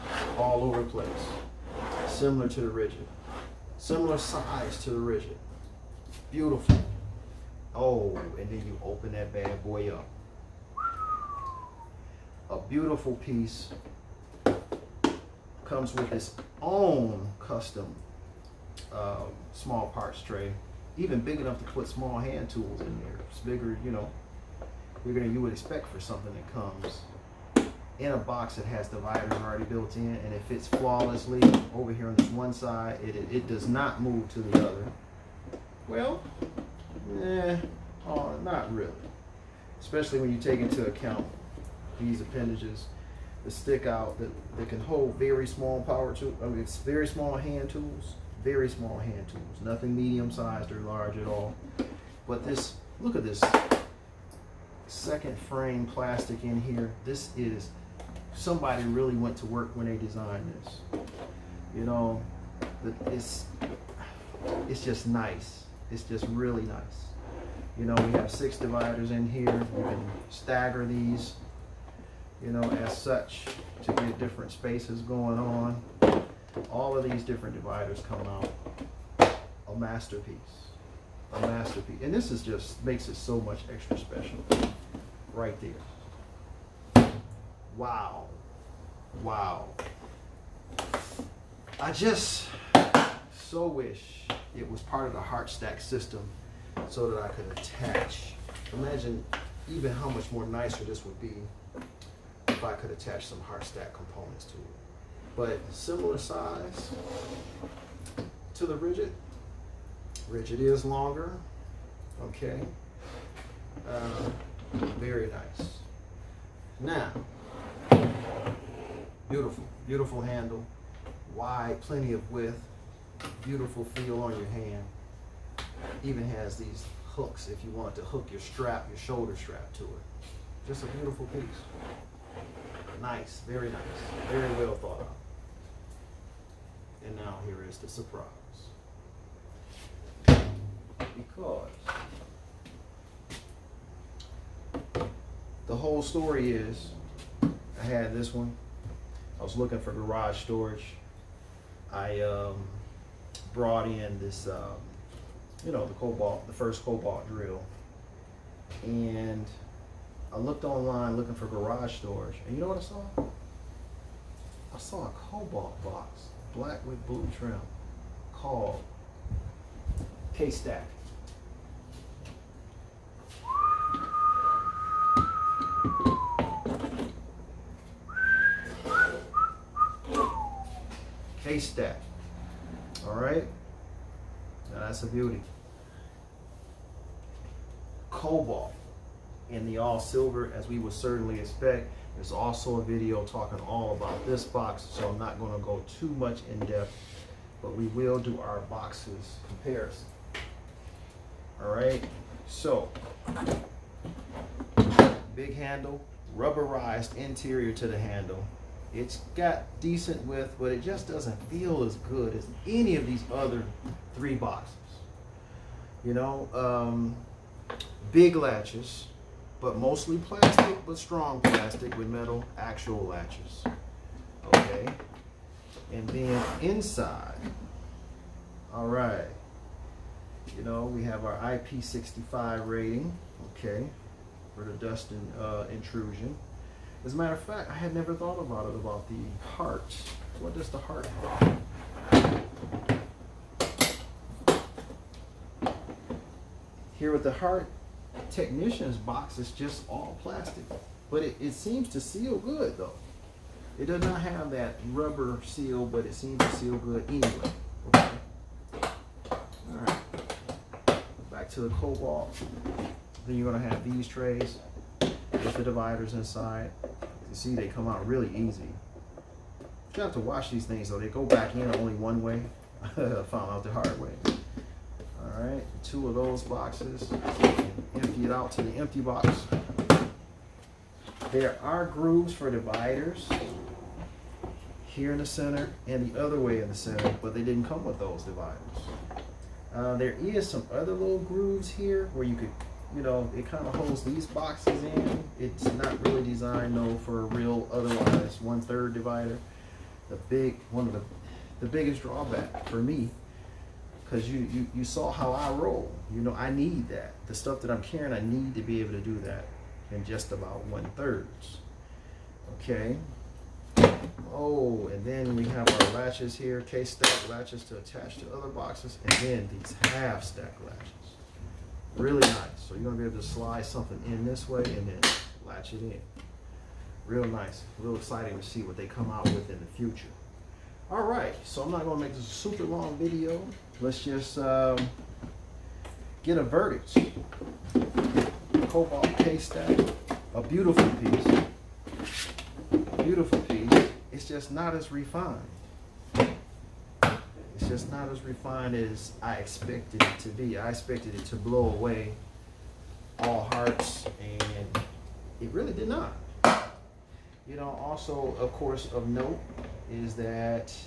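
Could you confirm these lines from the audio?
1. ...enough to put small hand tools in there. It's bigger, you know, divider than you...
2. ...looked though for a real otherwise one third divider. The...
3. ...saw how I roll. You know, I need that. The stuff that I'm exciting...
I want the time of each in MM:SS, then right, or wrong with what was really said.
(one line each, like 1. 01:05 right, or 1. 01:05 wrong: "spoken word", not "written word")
1. 00:21 wrong: "bigger", not "divider"
2. 04:56 wrong: "designed", not "looked"
3. 05:04 wrong: "carrying", not "exciting".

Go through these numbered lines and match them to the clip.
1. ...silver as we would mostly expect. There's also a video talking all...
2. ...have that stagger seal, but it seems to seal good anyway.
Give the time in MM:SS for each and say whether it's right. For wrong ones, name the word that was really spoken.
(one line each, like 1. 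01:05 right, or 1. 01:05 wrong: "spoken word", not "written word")
1. 03:09 wrong: "certainly", not "mostly"
2. 04:14 wrong: "rubber", not "stagger".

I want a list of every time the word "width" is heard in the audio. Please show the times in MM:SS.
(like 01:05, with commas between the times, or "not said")
02:02, 03:30.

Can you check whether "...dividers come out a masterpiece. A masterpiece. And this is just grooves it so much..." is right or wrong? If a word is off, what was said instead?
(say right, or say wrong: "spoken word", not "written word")
wrong: "makes", not "grooves".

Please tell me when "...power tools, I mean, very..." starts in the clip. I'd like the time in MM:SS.
00:45.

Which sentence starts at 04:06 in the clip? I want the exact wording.
Here with the Hart, technician's box is just all plastic.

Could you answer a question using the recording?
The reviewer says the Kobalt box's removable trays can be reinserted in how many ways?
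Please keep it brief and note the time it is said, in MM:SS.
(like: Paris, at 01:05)
Only one way, at 04:31.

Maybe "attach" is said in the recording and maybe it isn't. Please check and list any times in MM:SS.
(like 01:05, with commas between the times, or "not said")
01:37, 01:42, 05:17.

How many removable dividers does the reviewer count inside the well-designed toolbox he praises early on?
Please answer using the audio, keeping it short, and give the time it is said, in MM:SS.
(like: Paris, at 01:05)
6, at 01:08.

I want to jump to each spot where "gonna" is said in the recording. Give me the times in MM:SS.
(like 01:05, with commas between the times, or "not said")
03:15, 04:23, 05:22, 05:31.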